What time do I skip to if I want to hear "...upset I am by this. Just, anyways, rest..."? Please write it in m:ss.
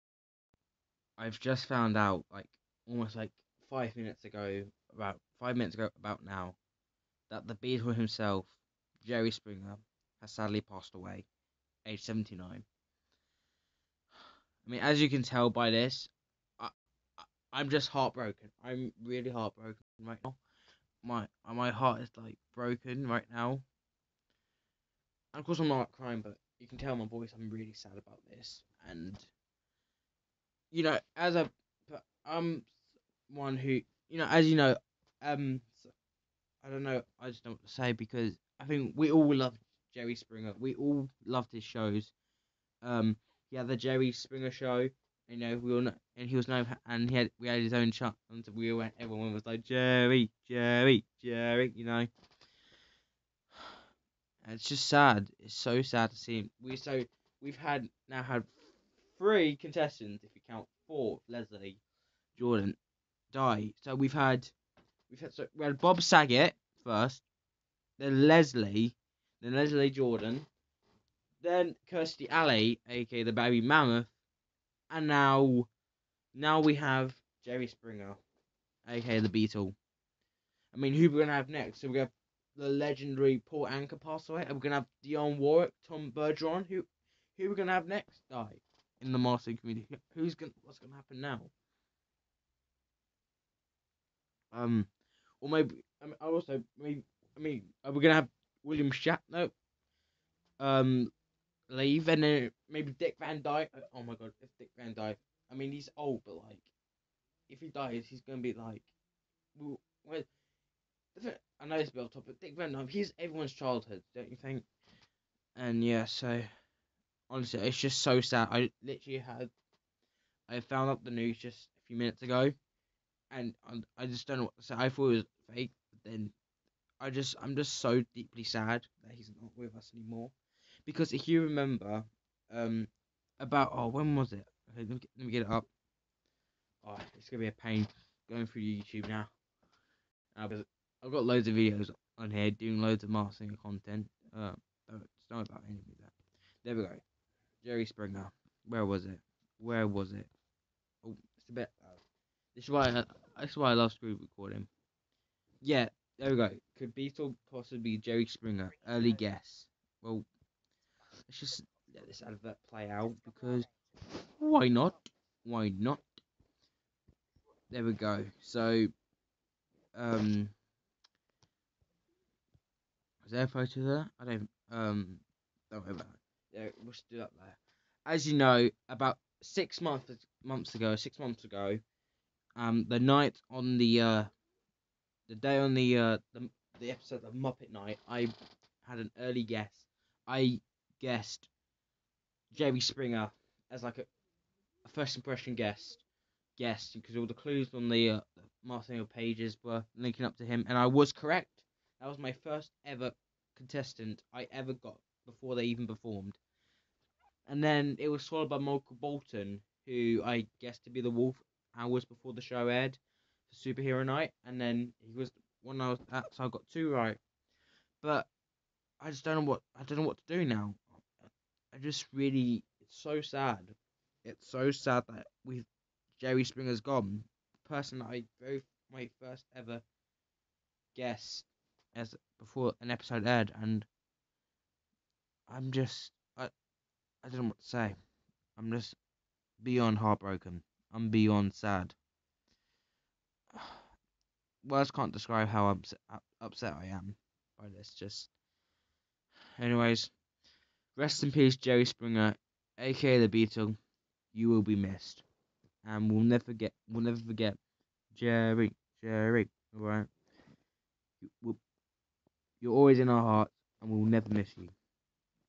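4:06.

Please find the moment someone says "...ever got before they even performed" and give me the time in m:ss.
3:24.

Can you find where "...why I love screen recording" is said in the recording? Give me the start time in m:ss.
2:33.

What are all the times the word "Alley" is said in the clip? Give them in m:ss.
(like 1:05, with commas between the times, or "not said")
1:12.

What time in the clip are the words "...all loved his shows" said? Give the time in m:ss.
0:40.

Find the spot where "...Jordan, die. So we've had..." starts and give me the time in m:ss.
1:02.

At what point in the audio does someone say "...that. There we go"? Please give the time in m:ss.
2:25.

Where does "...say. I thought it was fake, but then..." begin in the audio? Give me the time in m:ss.
2:04.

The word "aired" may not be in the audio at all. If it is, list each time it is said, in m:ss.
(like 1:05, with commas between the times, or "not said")
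3:32, 3:53.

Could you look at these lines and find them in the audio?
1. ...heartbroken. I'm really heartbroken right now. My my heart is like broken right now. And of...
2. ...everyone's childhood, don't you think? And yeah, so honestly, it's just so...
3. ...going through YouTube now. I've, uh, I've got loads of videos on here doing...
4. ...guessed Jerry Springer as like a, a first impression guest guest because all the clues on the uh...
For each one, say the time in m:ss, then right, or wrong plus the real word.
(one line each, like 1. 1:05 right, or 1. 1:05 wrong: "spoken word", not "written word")
1. 0:17 right
2. 1:53 right
3. 2:18 right
4. 3:10 right.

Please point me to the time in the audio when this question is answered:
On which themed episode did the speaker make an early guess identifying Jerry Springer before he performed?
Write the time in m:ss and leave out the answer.
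3:07.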